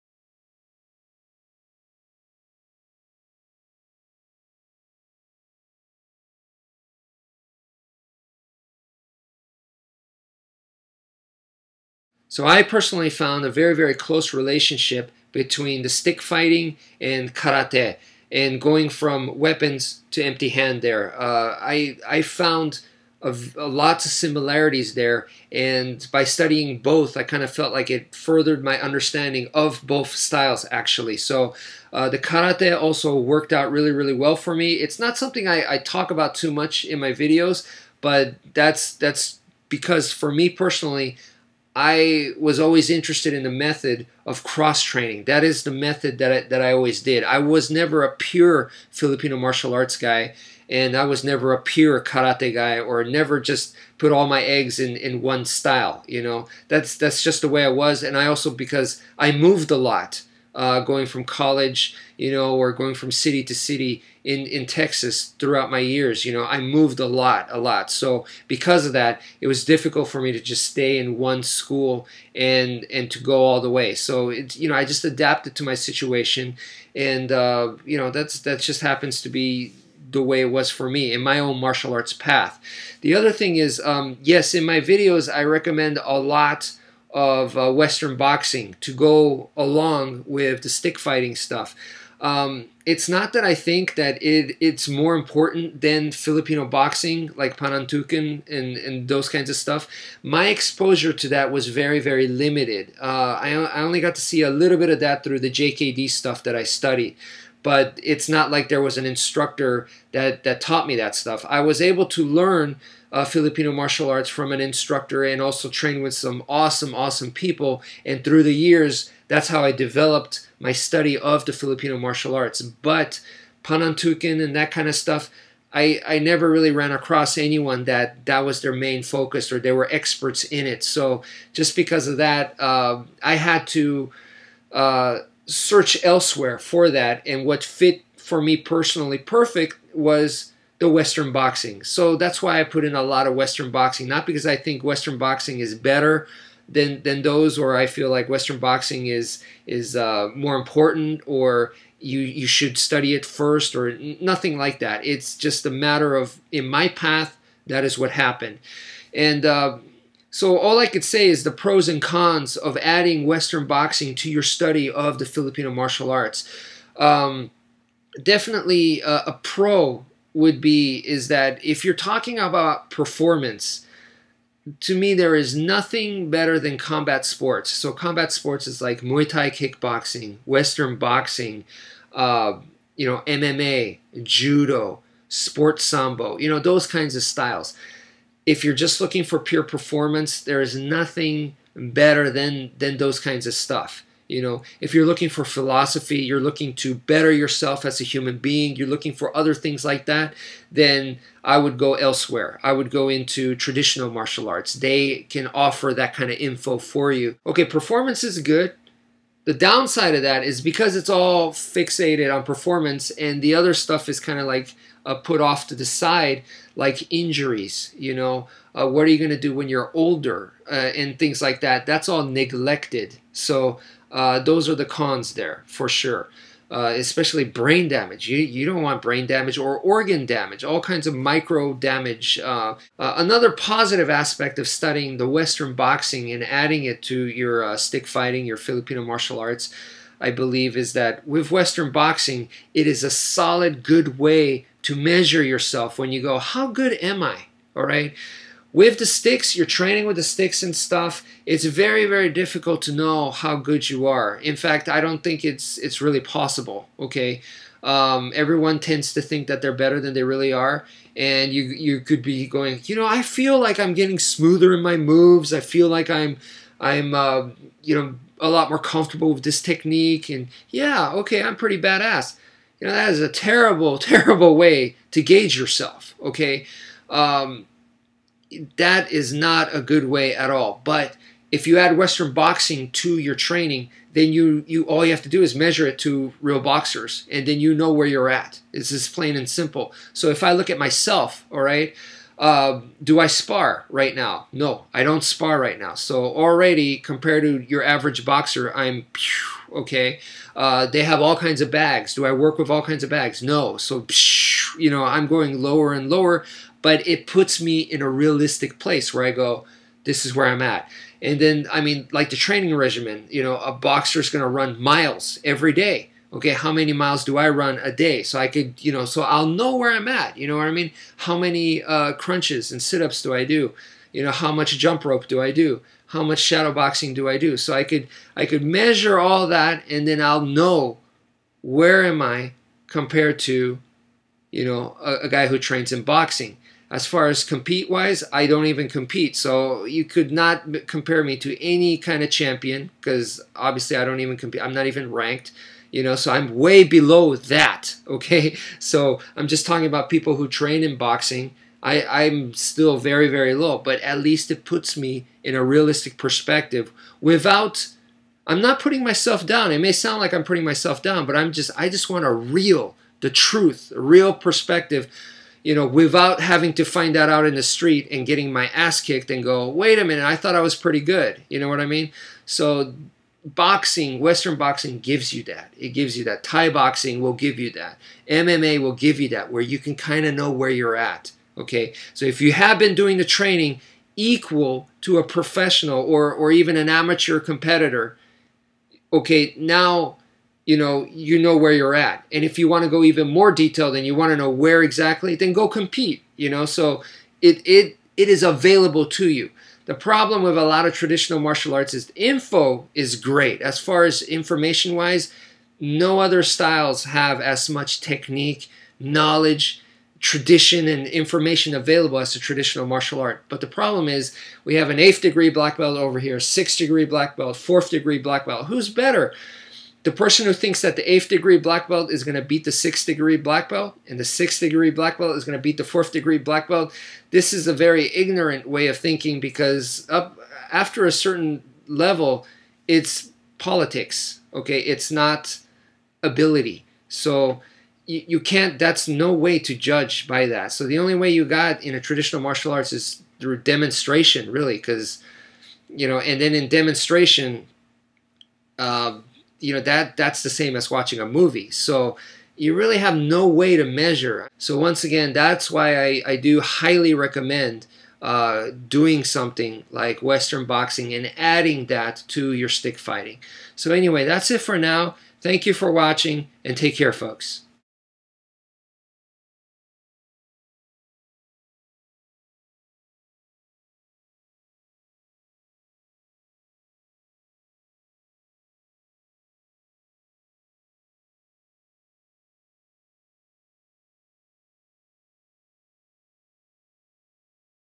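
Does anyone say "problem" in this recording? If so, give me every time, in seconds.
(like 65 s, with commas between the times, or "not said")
399 s, 413 s.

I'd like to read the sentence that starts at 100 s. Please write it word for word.
My exposure to that was very, very limited.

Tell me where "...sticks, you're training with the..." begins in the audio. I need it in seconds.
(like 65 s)
249 s.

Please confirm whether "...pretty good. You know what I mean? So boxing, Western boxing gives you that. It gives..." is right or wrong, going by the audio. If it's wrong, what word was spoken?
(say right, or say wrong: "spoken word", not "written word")
right.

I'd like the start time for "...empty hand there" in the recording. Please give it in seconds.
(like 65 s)
20 s.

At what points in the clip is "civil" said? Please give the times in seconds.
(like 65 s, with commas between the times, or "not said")
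not said.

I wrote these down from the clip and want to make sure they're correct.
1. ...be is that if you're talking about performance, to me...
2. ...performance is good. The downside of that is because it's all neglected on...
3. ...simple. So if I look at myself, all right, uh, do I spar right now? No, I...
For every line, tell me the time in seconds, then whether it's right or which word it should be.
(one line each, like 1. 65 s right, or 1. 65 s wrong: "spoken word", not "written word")
1. 170 s right
2. 207 s wrong: "fixated", not "neglected"
3. 289 s right.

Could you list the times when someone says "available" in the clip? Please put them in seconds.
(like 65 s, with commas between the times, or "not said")
398 s, 411 s.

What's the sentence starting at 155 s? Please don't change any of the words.
It's just a matter of in my path that is what happened, and.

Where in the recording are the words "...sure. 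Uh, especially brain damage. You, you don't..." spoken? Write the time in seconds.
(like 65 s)
225 s.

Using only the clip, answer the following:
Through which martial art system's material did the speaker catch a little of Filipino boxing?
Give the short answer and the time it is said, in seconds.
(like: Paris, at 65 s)
JKD, at 105 s.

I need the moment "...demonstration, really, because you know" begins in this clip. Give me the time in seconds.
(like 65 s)
443 s.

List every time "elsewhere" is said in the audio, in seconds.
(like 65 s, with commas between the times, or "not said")
136 s, 201 s.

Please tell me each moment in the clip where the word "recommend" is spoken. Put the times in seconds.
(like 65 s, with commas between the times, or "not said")
85 s, 457 s.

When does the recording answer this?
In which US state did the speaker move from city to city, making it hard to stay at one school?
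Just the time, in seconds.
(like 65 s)
64 s.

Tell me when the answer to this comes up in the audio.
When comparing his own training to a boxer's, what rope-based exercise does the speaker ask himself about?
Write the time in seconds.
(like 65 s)
324 s.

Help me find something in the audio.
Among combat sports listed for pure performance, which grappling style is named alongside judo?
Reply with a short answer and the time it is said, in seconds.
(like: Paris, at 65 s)
Sports sambo, at 185 s.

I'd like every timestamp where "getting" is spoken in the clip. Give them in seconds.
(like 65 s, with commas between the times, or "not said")
263 s, 368 s.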